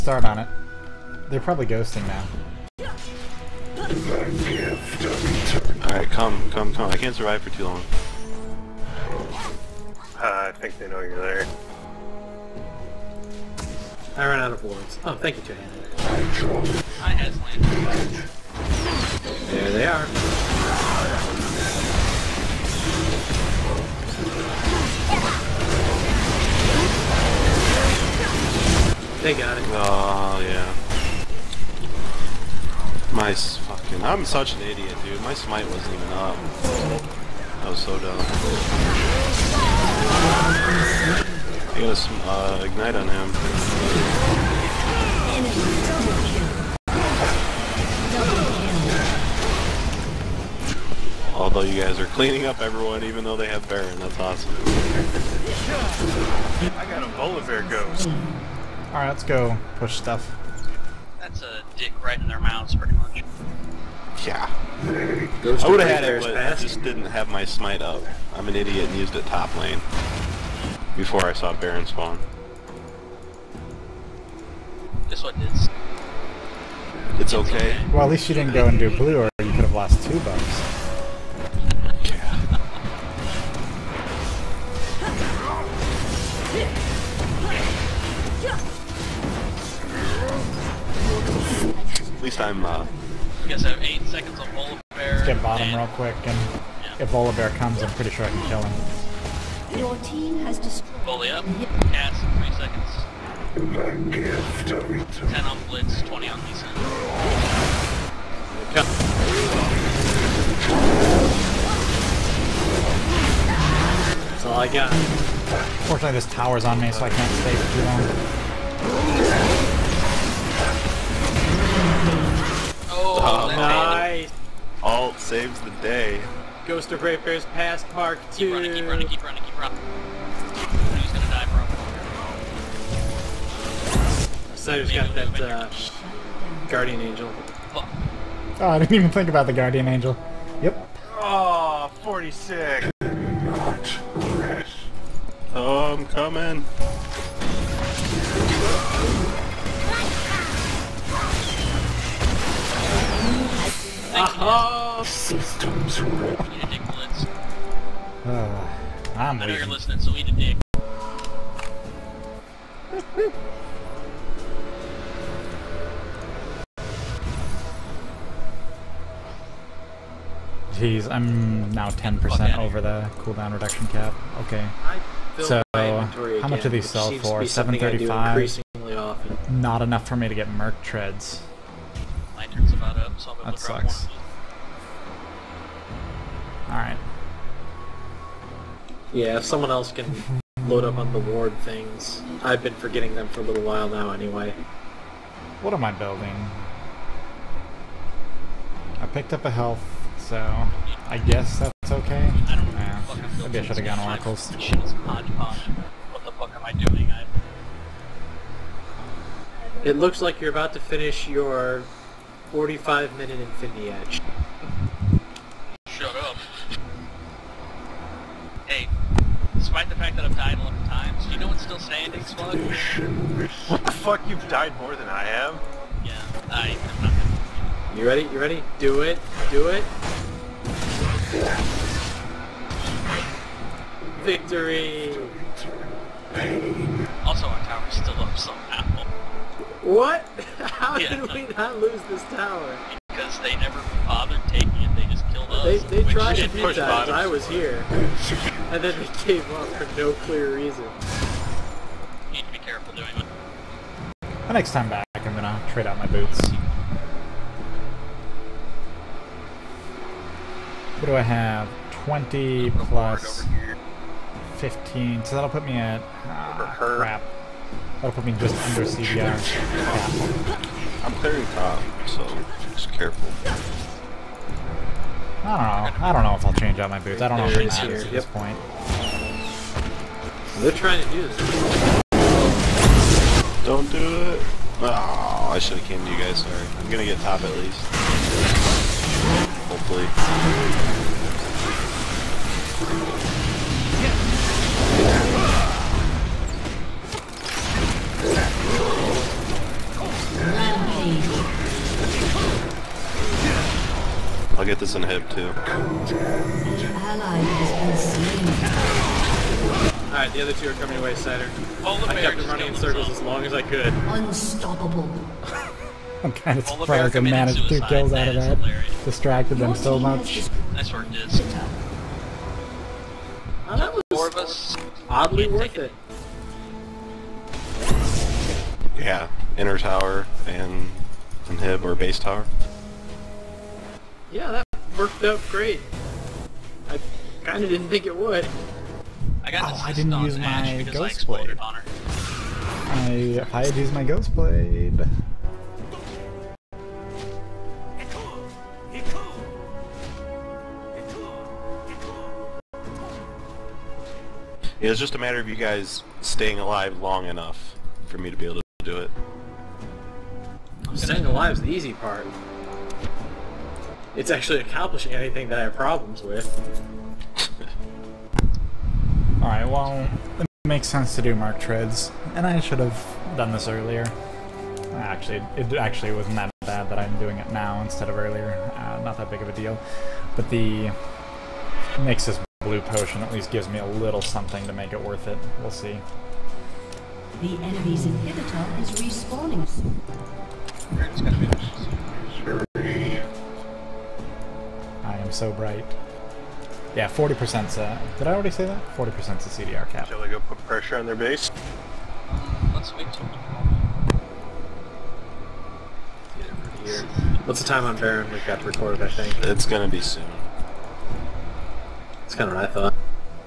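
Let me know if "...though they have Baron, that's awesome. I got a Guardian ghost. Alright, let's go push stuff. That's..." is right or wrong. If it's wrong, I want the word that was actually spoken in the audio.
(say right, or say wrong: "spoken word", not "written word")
wrong: "Volibear", not "Guardian".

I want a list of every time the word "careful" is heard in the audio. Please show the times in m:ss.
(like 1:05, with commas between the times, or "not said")
4:12, 4:32.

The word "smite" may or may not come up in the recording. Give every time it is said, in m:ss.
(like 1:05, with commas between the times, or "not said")
0:35, 1:07.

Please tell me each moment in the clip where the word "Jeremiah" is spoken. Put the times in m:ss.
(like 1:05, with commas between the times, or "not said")
not said.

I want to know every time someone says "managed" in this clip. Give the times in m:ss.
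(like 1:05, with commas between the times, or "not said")
5:17.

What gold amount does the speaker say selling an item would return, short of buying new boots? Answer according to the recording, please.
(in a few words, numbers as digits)
735.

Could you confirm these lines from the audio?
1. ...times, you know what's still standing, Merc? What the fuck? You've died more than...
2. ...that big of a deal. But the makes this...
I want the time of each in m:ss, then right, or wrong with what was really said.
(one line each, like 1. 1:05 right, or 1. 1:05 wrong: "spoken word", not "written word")
1. 3:40 wrong: "Slug", not "Merc"
2. 6:19 right.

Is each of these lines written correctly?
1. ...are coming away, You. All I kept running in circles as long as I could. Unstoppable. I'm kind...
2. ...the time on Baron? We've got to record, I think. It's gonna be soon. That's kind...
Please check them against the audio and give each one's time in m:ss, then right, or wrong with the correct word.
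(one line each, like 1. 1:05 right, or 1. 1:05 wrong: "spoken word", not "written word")
1. 5:10 wrong: "Saturn", not "You"
2. 6:47 right.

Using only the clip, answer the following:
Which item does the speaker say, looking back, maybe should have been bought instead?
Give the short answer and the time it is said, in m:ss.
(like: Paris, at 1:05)
Oracles, at 3:24.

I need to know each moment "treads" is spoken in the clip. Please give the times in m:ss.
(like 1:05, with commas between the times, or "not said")
3:00, 6:11.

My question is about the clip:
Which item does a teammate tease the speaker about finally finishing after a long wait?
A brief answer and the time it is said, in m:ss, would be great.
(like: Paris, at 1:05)
Infinity Edge, at 3:33.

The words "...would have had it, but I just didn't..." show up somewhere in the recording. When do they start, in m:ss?
1:05.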